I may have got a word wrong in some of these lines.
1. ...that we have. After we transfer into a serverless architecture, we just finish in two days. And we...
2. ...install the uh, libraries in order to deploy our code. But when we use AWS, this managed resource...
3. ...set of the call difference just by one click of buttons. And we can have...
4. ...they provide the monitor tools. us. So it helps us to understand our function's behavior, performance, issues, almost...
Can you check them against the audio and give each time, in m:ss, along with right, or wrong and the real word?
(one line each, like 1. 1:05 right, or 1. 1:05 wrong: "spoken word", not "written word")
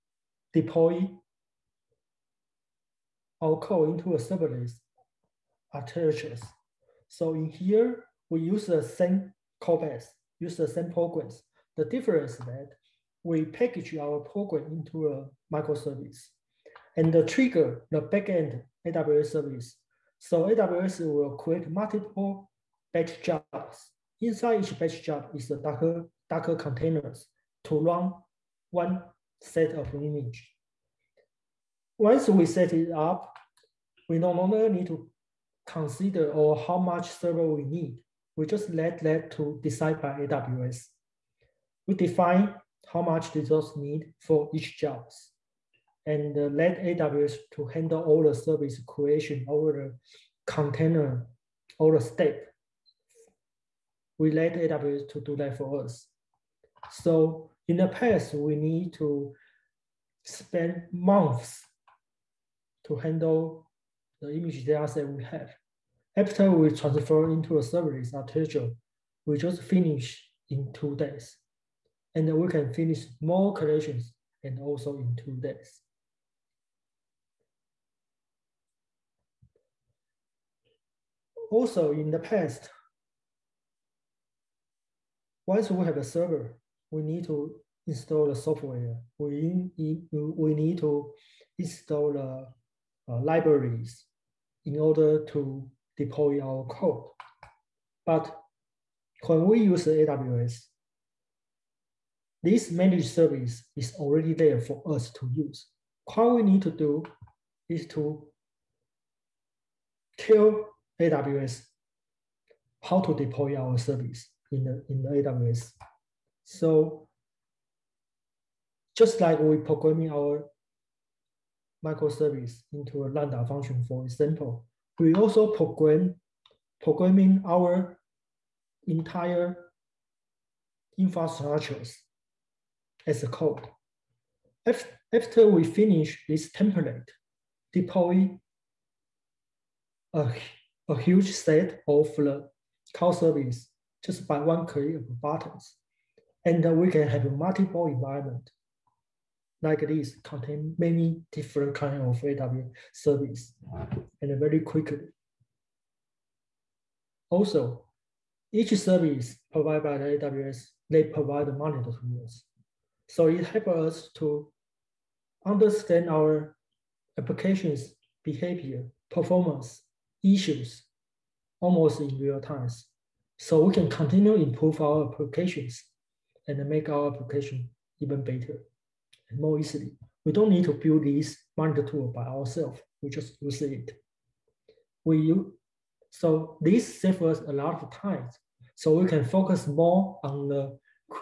1. 1:04 right
2. 1:31 wrong: "service", not "resource"
3. 2:21 wrong: "service", not "difference"
4. 2:40 wrong: "application", not "function".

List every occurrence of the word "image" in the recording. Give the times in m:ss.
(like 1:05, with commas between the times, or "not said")
0:29, 1:04.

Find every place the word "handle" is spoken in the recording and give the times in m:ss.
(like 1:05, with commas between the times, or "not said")
0:47, 1:02.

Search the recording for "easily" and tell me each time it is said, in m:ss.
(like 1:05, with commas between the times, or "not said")
2:59.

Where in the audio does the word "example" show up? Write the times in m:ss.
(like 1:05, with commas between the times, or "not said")
2:04.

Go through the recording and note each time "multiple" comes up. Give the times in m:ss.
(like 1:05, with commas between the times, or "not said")
0:21, 2:27.